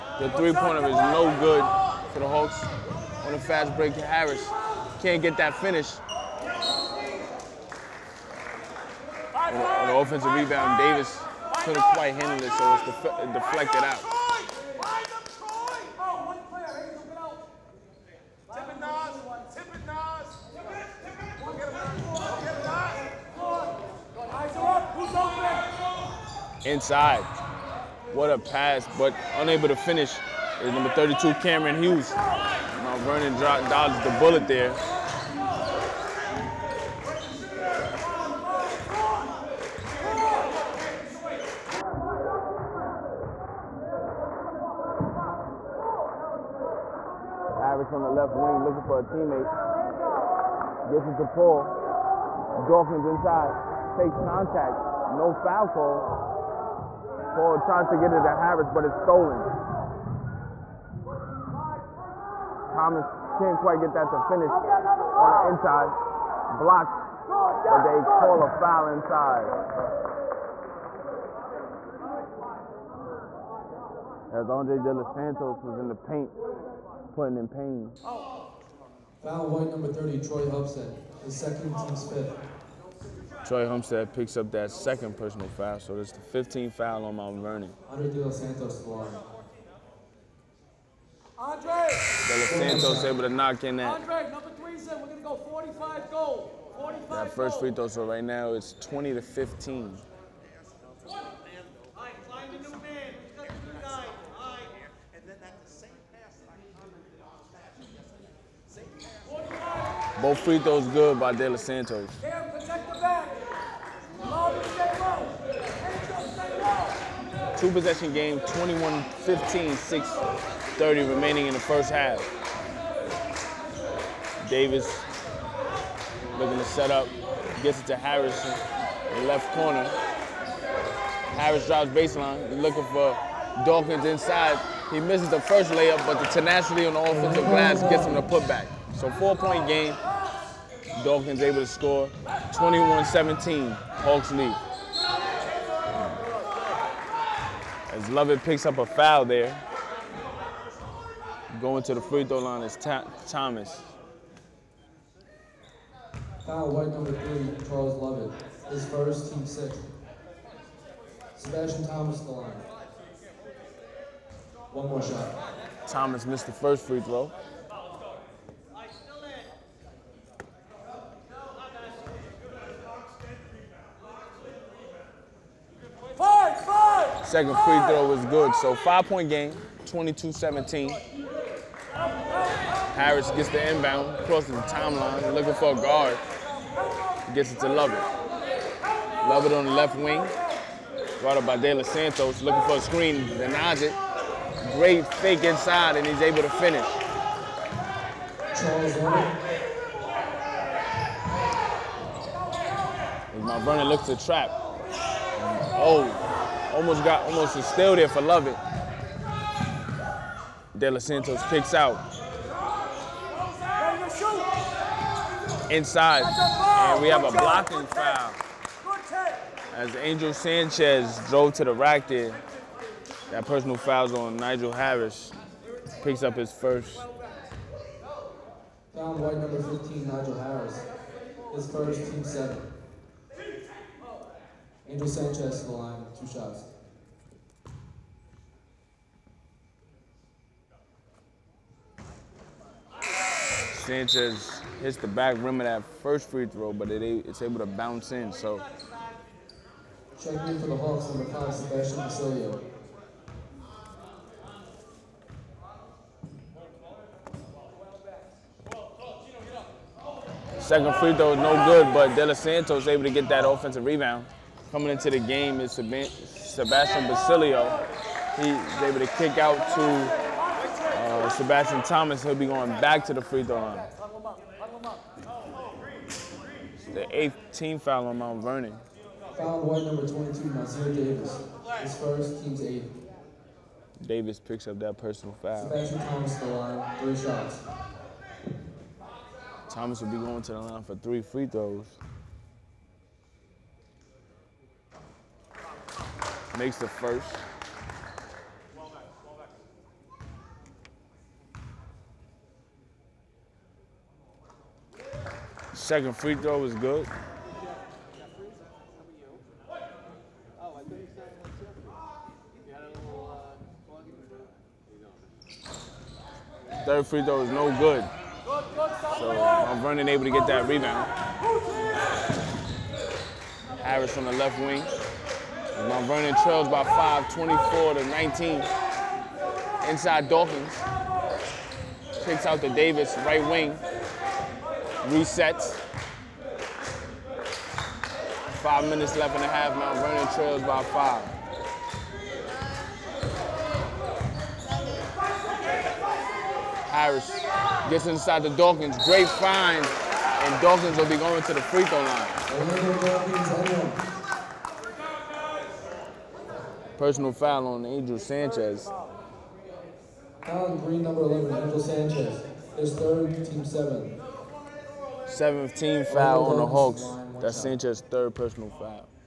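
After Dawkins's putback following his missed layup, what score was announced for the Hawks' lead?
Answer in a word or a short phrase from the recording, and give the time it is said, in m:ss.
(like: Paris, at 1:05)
21-17, at 2:22.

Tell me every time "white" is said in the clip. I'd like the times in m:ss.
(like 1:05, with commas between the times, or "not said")
1:19, 2:36, 3:49.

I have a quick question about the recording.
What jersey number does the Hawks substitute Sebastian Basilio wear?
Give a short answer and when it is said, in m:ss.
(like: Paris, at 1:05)
5, at 4:11.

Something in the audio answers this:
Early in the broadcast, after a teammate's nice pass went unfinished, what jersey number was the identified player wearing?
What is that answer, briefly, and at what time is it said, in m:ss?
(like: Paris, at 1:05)
32, at 0:30.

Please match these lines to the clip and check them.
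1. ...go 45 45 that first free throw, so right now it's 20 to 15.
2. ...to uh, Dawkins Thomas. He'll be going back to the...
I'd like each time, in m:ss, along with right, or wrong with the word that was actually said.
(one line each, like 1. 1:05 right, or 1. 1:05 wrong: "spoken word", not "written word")
1. 1:35 right
2. 4:29 wrong: "Sebastian", not "Dawkins".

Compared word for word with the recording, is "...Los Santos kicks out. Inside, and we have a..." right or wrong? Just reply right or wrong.
right.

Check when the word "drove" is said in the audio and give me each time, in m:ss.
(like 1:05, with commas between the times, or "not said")
3:41.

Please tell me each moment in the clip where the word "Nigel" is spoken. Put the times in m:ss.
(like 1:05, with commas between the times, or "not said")
3:44, 3:50.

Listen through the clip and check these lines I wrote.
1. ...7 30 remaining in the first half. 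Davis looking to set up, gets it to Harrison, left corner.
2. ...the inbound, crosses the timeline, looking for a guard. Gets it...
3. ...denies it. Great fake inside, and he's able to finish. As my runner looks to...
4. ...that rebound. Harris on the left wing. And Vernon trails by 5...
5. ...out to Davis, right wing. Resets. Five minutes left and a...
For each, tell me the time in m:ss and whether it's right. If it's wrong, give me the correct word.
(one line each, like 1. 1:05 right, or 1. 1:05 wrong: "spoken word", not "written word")
1. 1:59 wrong: "6", not "7"
2. 3:03 right
3. 3:13 right
4. 5:20 right
5. 5:32 right.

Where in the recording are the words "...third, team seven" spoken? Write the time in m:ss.
6:02.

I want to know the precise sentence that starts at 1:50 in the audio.
Both free throws good by De Los Santos.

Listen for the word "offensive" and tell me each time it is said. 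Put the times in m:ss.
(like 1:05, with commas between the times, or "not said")
0:09, 2:17, 4:23.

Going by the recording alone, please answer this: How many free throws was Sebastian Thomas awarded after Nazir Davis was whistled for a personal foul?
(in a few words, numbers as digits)
3.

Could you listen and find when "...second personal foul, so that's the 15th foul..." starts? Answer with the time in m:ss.
1:24.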